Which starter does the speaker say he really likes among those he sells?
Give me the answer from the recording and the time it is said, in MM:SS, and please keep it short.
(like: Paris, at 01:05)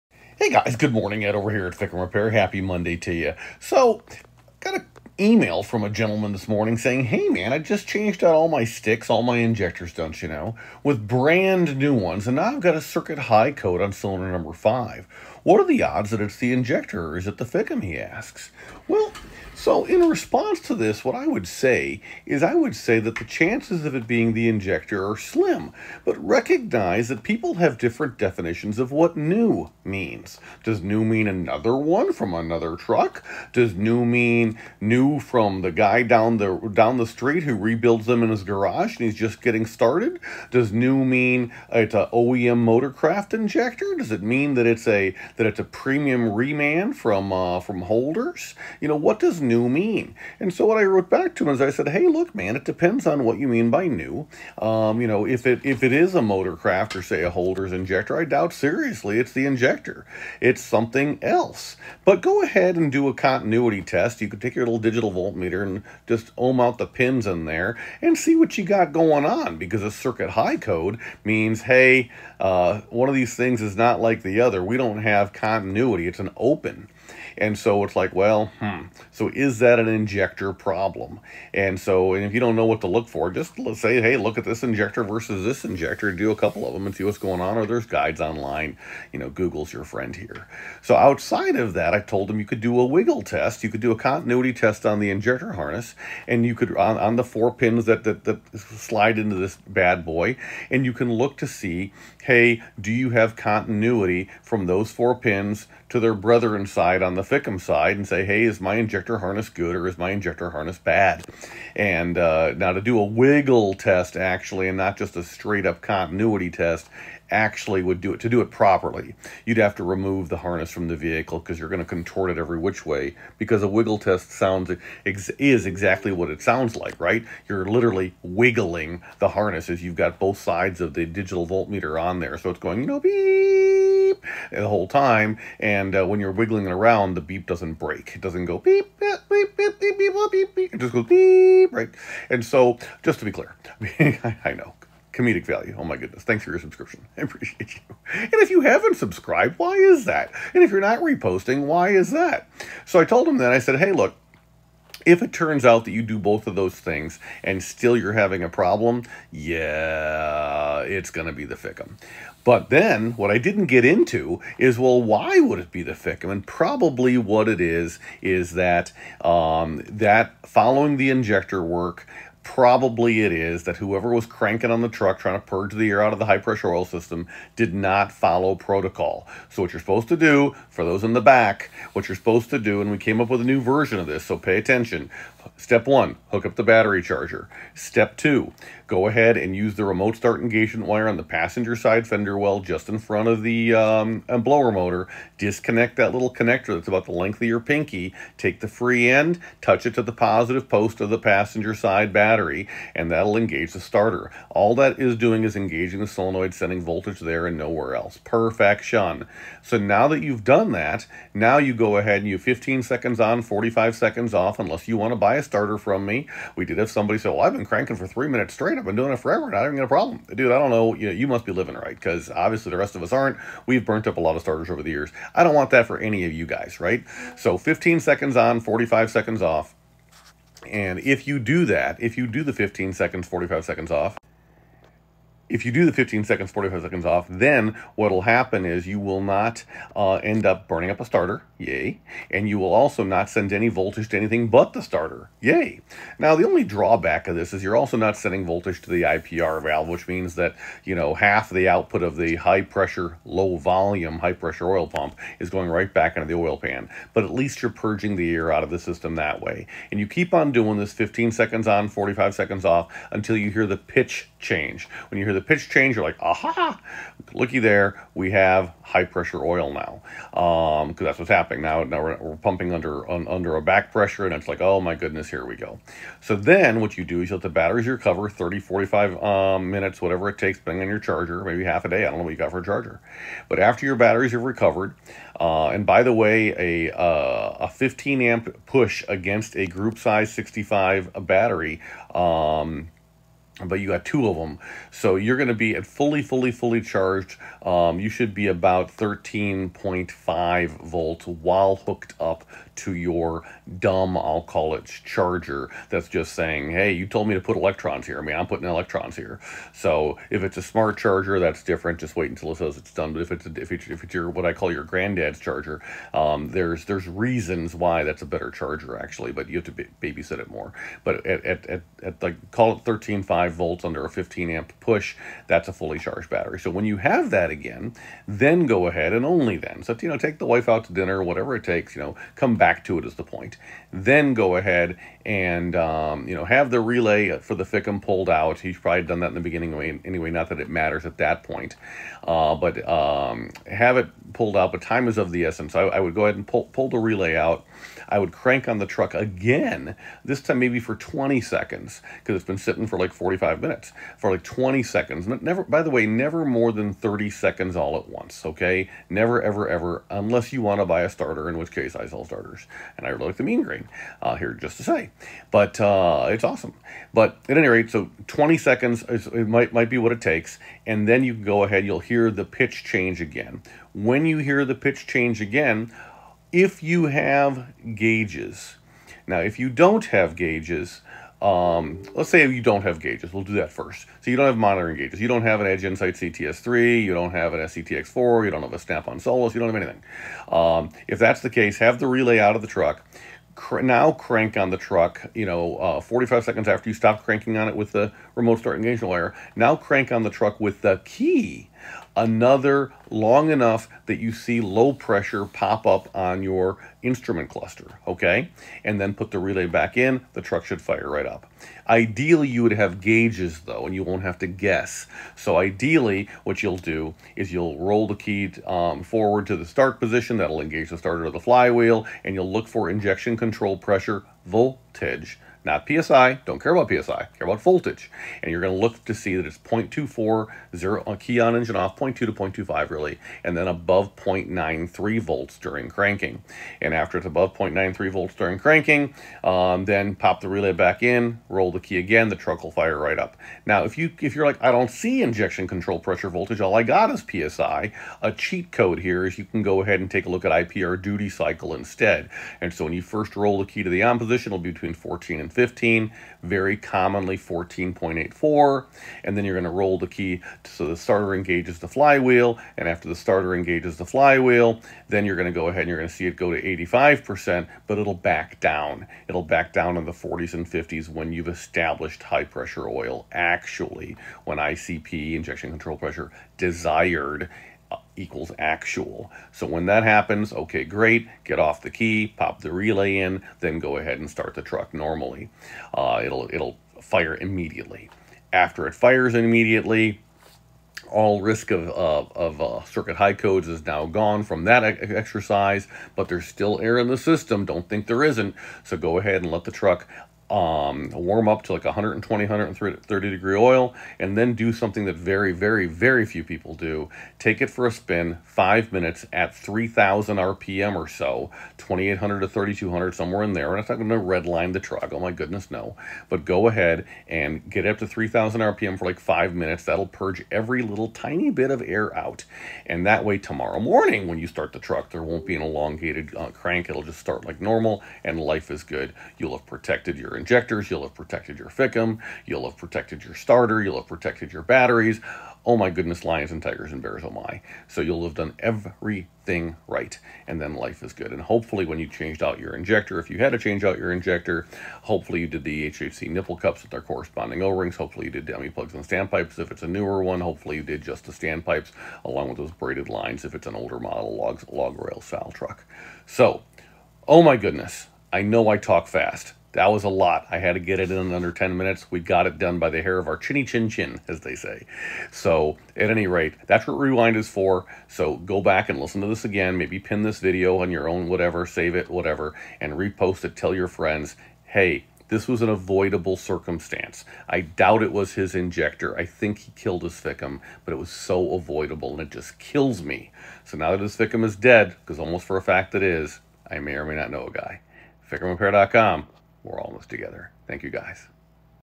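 Mean green, at 06:03.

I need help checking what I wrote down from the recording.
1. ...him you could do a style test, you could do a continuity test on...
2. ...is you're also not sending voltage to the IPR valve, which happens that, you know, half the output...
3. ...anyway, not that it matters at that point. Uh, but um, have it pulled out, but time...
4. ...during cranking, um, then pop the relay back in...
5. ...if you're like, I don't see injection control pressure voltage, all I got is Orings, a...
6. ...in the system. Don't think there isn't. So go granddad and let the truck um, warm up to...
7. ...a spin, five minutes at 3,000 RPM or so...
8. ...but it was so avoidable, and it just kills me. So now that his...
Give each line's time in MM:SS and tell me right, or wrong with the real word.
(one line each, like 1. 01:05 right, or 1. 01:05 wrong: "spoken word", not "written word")
1. 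01:32 wrong: "wiggle", not "style"
2. 04:07 wrong: "means", not "happens"
3. 05:40 right
4. 07:18 right
5. 07:24 wrong: "PSI", not "Orings"
6. 08:16 wrong: "ahead", not "granddad"
7. 08:27 right
8. 09:40 right.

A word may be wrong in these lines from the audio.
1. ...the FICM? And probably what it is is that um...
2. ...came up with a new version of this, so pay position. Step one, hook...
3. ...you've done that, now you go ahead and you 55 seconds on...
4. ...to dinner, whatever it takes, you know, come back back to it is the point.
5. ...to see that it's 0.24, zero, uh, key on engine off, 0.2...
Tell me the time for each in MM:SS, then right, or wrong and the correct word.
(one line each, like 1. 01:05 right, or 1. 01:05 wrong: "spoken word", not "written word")
1. 02:45 right
2. 03:02 wrong: "attention", not "position"
3. 03:30 wrong: "15", not "55"
4. 05:30 right
5. 07:09 right.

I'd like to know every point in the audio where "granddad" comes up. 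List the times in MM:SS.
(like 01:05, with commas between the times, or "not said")
05:14.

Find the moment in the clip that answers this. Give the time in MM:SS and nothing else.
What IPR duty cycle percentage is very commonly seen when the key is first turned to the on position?
07:37.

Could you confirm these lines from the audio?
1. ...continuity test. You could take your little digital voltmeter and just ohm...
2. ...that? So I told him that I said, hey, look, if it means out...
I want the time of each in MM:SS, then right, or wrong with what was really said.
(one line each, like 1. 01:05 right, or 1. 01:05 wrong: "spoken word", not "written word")
1. 01:03 right
2. 02:32 wrong: "turns", not "means".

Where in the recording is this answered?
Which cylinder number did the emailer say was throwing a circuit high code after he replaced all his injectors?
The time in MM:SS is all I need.
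00:13.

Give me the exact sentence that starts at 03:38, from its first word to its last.
I've been doing it forever, not having a problem.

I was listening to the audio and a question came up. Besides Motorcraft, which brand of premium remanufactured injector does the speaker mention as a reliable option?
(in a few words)
Holders.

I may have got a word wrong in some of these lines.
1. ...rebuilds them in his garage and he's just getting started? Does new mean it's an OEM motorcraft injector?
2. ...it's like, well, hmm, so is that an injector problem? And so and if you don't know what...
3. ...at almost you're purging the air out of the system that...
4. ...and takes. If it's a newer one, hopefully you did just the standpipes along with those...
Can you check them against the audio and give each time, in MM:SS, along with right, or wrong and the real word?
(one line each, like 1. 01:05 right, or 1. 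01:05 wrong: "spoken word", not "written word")
1. 00:37 right
2. 01:17 right
3. 04:17 wrong: "least", not "almost"
4. 09:08 wrong: "standpipes", not "takes".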